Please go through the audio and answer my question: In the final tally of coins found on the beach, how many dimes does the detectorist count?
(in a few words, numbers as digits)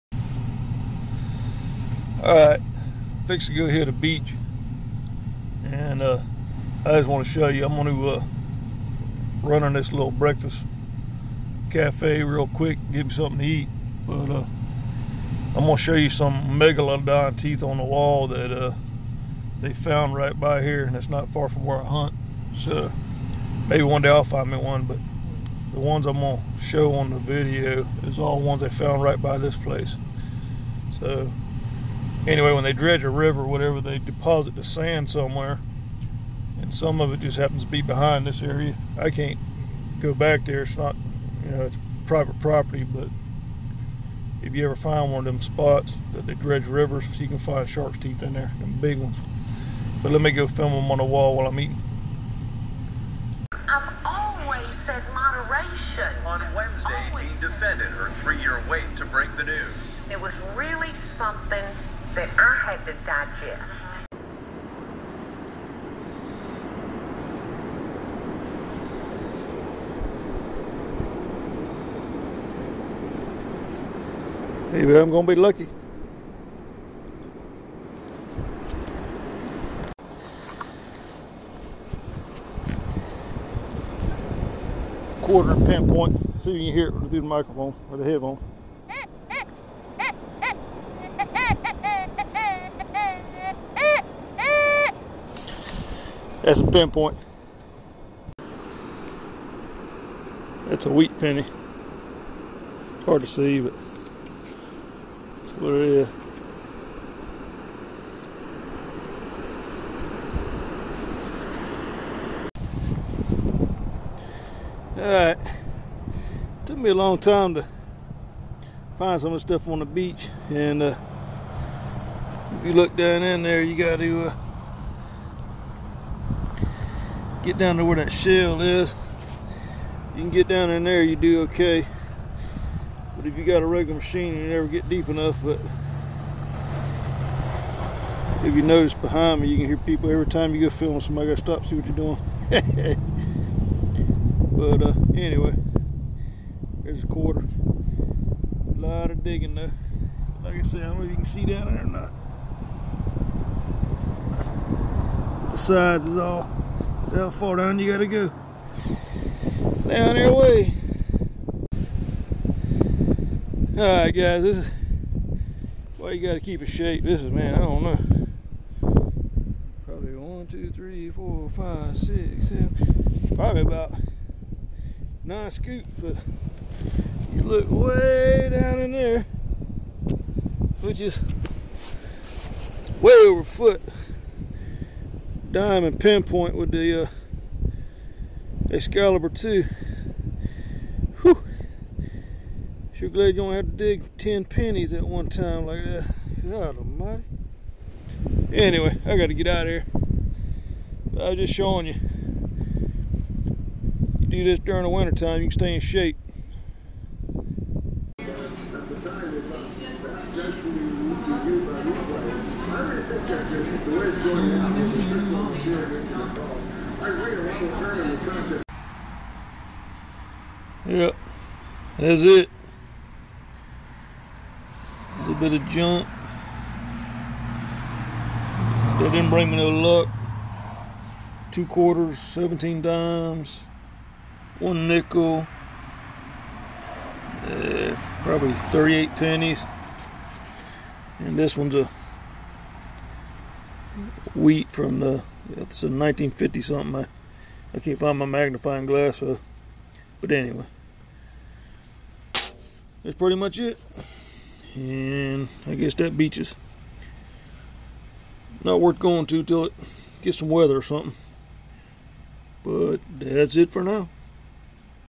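17.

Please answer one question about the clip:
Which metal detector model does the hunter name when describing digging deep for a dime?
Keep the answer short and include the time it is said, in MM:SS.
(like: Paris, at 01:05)
Excalibur 2, at 03:08.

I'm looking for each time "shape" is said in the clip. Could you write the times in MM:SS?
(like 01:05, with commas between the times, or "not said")
02:46, 03:25.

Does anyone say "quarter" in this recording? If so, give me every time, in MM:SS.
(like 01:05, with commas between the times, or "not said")
01:25, 02:27, 03:51.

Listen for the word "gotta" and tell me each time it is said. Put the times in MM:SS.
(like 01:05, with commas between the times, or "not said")
02:21, 02:37, 02:46, 03:19.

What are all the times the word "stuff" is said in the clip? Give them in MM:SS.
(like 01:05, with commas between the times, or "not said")
01:59.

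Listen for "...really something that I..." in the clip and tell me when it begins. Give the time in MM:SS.
01:00.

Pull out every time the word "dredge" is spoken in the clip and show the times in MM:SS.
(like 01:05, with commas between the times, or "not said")
00:32, 00:46.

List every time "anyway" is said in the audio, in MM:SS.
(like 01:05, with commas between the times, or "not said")
00:32, 02:25, 03:18, 04:10.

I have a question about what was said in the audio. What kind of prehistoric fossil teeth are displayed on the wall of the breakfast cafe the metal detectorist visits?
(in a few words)
Megalodon teeth.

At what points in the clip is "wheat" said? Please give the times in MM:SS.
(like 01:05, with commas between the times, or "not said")
01:40, 04:04.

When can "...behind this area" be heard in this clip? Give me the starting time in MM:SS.
00:37.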